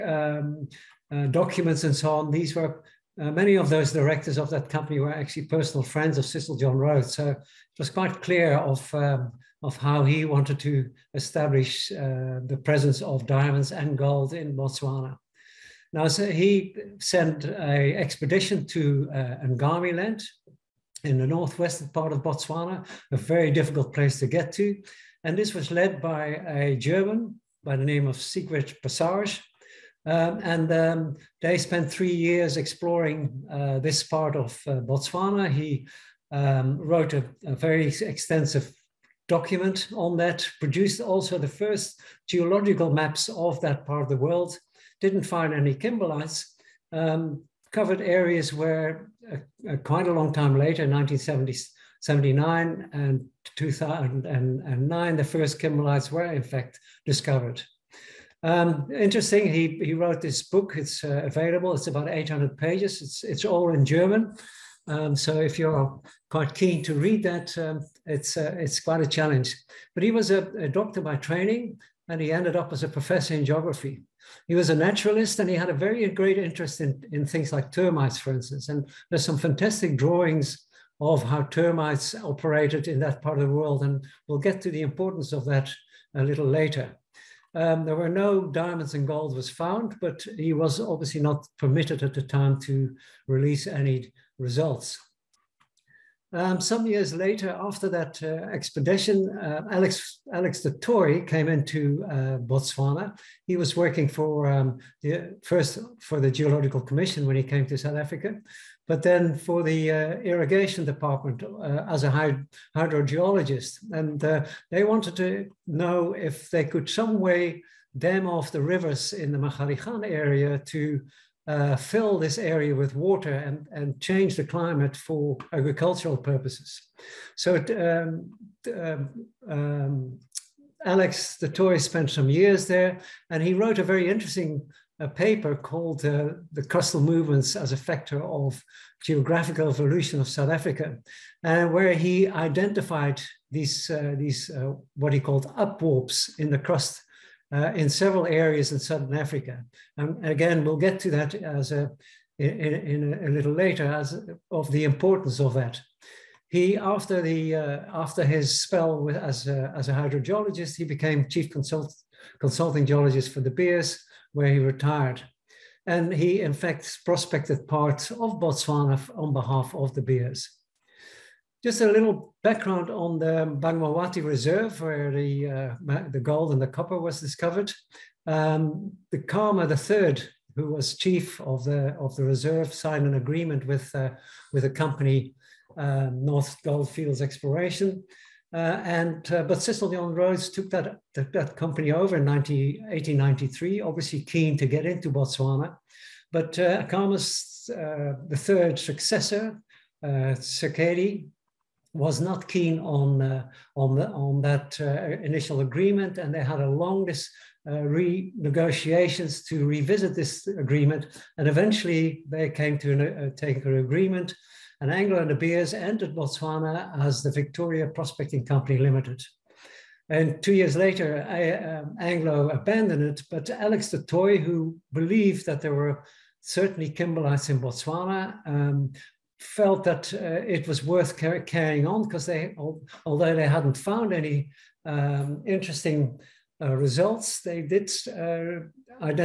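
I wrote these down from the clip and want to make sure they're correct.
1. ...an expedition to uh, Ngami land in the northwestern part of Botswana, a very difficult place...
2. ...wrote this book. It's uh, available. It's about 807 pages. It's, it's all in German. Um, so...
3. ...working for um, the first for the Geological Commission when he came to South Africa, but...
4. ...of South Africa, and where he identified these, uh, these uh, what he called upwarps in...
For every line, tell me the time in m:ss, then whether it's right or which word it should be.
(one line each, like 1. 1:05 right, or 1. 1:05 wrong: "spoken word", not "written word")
1. 0:17 right
2. 1:00 wrong: "800", not "807"
3. 1:43 right
4. 2:20 right.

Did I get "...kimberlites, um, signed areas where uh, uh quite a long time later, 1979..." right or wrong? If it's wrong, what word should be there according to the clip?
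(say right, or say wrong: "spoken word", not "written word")
wrong: "covered", not "signed".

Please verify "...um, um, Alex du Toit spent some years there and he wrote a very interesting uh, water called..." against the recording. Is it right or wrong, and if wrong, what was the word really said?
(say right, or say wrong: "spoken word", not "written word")
wrong: "paper", not "water".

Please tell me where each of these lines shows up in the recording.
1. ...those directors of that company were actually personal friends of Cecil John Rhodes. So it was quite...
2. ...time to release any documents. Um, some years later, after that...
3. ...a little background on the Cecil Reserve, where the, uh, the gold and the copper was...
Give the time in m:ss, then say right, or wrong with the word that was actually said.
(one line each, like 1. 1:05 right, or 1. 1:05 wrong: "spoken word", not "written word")
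1. 0:03 right
2. 1:32 wrong: "results", not "documents"
3. 2:51 wrong: "Bamangwato", not "Cecil".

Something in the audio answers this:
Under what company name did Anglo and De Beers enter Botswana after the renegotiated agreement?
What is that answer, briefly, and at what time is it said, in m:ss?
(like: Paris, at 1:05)
Victoria Prospecting Company Limited, at 3:37.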